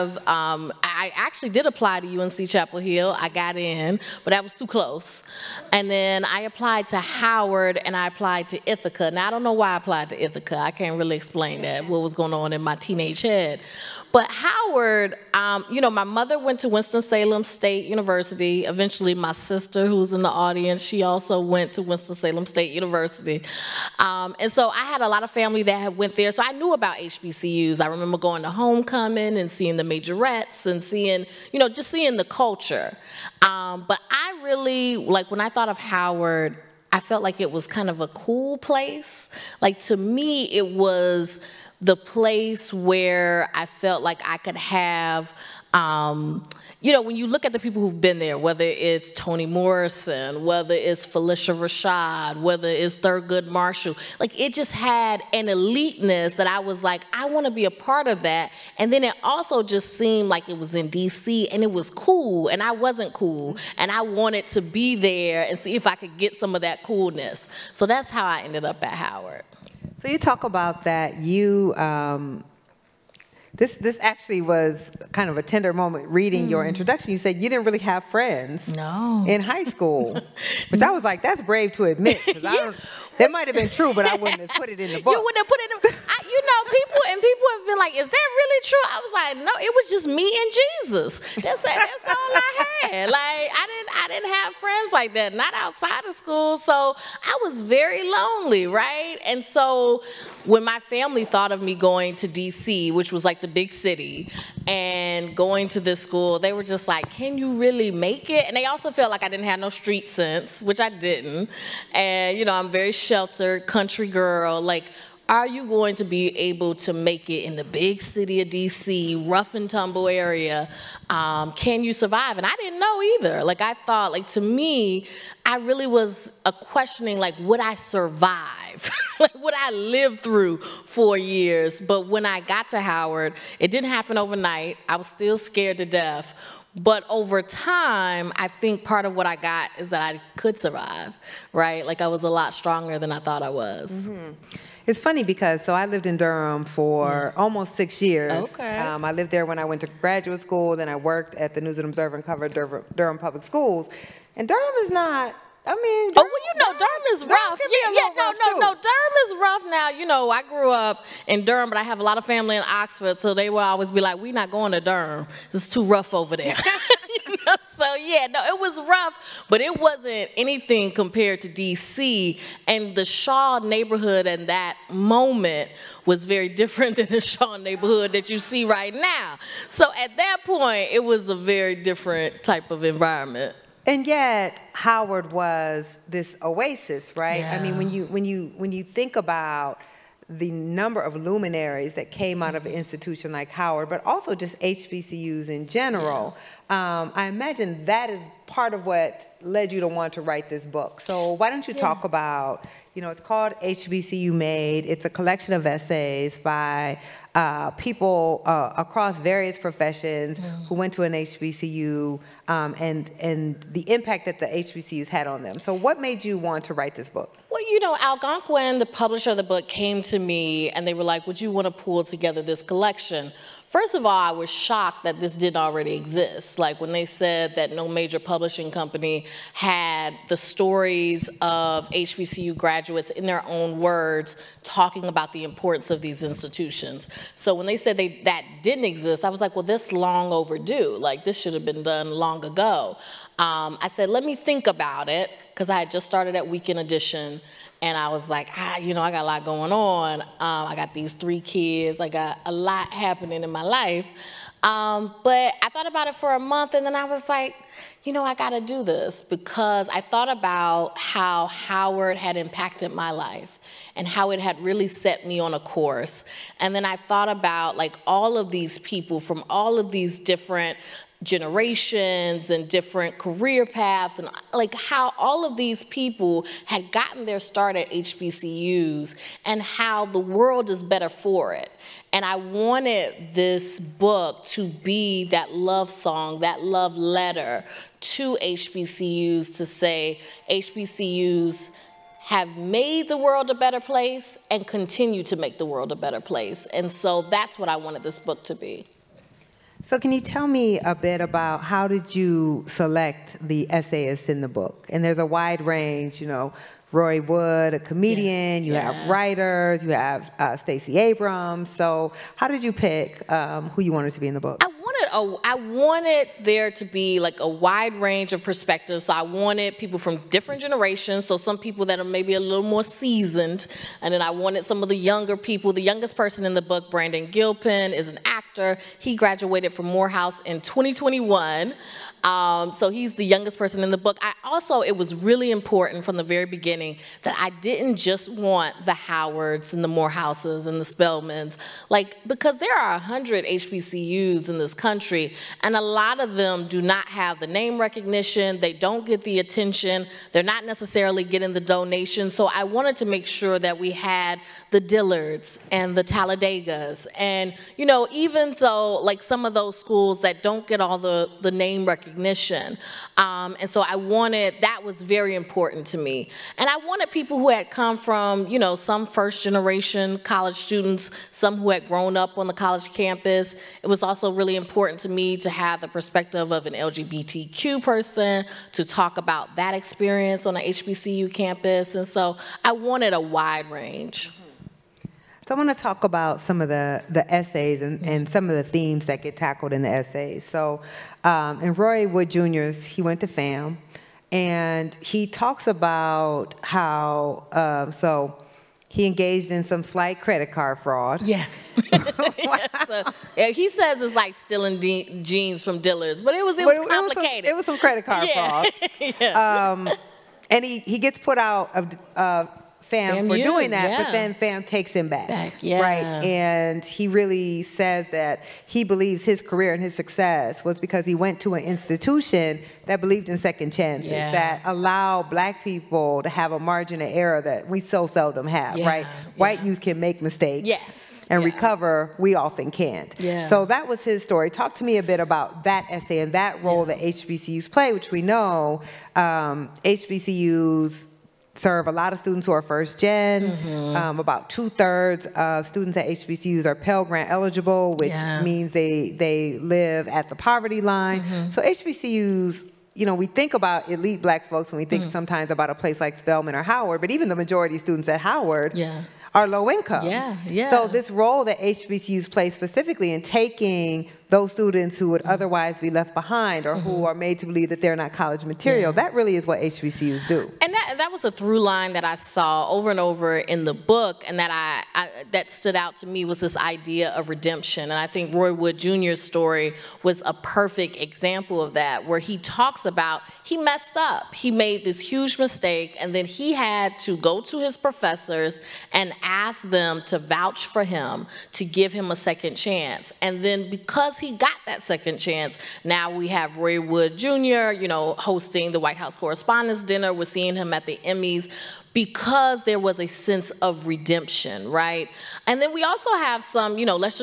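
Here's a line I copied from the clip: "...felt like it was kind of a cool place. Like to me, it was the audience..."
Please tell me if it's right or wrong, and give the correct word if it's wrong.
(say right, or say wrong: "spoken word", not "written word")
wrong: "place", not "audience".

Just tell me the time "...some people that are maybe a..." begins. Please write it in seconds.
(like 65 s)
321 s.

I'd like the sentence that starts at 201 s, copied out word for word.
talk about, you know, it's called HBCU Made.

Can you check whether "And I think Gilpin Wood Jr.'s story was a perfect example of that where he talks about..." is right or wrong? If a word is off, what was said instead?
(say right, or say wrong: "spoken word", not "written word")
wrong: "Roy", not "Gilpin".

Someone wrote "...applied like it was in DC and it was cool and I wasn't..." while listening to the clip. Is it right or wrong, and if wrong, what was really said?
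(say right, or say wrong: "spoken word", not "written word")
wrong: "seemed", not "applied".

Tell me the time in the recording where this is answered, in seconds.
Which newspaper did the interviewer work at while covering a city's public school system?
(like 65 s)
151 s.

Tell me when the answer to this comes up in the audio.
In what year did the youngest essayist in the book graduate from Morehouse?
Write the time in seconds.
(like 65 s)
330 s.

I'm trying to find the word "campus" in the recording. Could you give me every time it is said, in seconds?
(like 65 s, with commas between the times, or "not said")
372 s, 381 s.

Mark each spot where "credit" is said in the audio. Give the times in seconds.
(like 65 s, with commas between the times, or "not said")
400 s, 408 s.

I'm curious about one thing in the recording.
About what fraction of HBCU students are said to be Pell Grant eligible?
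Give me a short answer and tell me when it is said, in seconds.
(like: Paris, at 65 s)
Two thirds, at 444 s.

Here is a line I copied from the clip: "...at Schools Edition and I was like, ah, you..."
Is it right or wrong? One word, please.
wrong.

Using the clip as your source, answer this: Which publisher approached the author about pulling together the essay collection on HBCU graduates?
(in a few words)
Algonquin.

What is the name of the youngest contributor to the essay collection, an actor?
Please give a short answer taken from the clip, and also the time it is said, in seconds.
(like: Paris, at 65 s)
Brandon Gilpin, at 326 s.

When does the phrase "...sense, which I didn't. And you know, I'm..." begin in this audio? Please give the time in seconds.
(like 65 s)
110 s.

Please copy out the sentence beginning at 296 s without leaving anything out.
And so that's what I wanted this book to be.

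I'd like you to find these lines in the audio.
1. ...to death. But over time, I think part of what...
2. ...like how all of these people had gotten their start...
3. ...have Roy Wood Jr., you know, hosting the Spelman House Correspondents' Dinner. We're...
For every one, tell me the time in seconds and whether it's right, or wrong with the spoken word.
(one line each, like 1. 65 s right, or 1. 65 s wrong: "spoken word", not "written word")
1. 135 s right
2. 274 s right
3. 496 s wrong: "White", not "Spelman".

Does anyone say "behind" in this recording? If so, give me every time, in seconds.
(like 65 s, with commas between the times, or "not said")
466 s.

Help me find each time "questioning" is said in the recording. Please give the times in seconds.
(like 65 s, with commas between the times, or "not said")
126 s.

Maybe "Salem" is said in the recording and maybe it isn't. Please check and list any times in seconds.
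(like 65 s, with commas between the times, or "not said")
16 s, 21 s.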